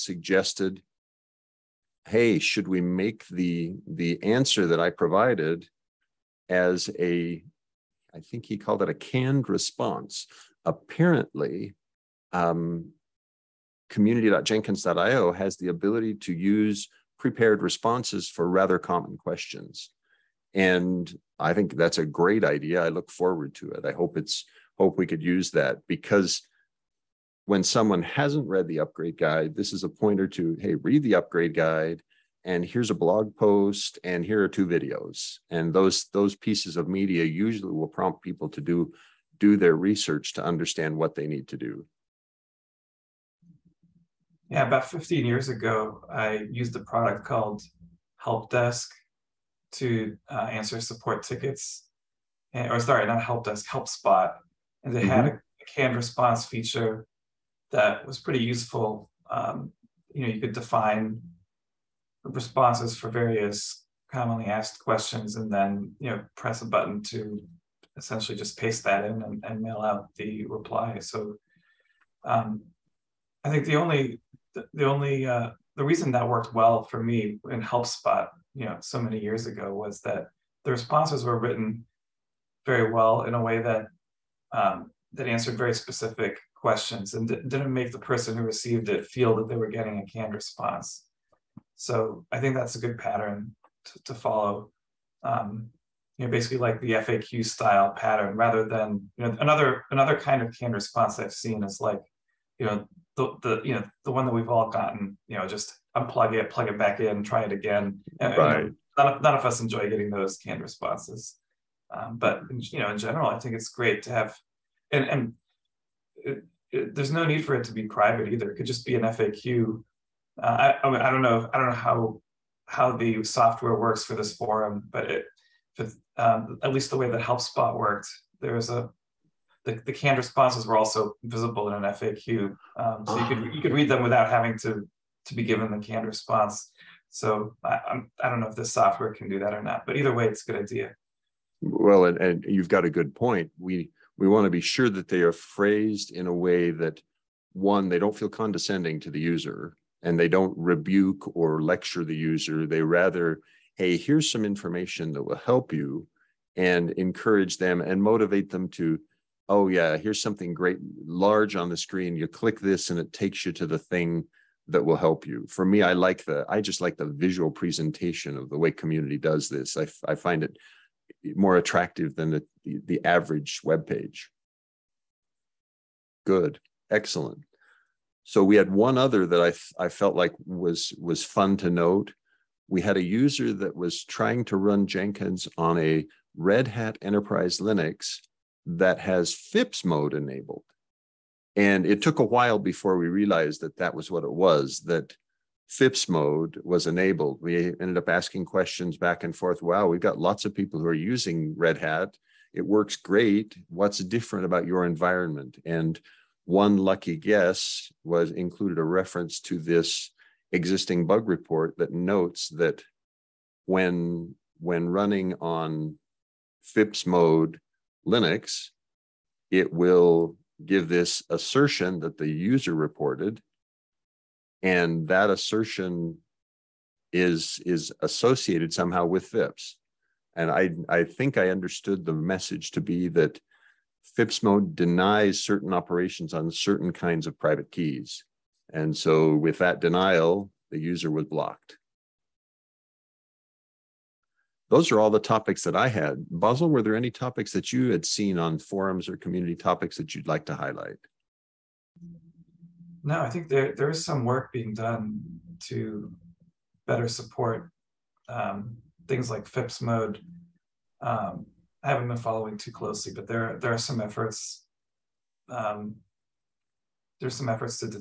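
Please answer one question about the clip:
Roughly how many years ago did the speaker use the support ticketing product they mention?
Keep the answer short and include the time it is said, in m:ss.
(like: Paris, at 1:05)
15 years, at 0:44.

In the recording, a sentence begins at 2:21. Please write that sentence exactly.
Well, and, and you've got a good point.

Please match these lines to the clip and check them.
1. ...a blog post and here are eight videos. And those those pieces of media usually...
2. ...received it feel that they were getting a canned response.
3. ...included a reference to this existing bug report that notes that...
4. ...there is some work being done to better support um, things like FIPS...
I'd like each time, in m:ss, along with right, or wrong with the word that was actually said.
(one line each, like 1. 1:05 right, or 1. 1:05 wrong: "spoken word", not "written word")
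1. 0:32 wrong: "two", not "eight"
2. 1:28 right
3. 3:28 right
4. 4:13 right.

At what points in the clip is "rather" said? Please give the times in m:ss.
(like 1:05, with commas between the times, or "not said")
0:18, 1:38, 2:32.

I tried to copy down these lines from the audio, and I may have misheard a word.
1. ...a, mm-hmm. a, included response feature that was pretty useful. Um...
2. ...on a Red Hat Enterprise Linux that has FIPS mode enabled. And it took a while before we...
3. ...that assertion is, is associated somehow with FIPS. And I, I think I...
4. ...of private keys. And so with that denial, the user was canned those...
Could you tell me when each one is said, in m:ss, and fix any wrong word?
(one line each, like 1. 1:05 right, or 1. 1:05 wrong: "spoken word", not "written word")
1. 0:55 wrong: "canned", not "included"
2. 3:05 right
3. 3:45 right
4. 3:57 wrong: "blocked", not "canned".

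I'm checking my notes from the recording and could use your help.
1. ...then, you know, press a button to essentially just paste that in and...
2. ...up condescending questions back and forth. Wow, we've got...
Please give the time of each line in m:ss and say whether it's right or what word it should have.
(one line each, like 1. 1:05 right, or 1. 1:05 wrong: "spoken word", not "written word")
1. 1:05 right
2. 3:17 wrong: "asking", not "condescending".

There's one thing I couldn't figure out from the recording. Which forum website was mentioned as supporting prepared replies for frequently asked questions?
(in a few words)
community.jenkins.io.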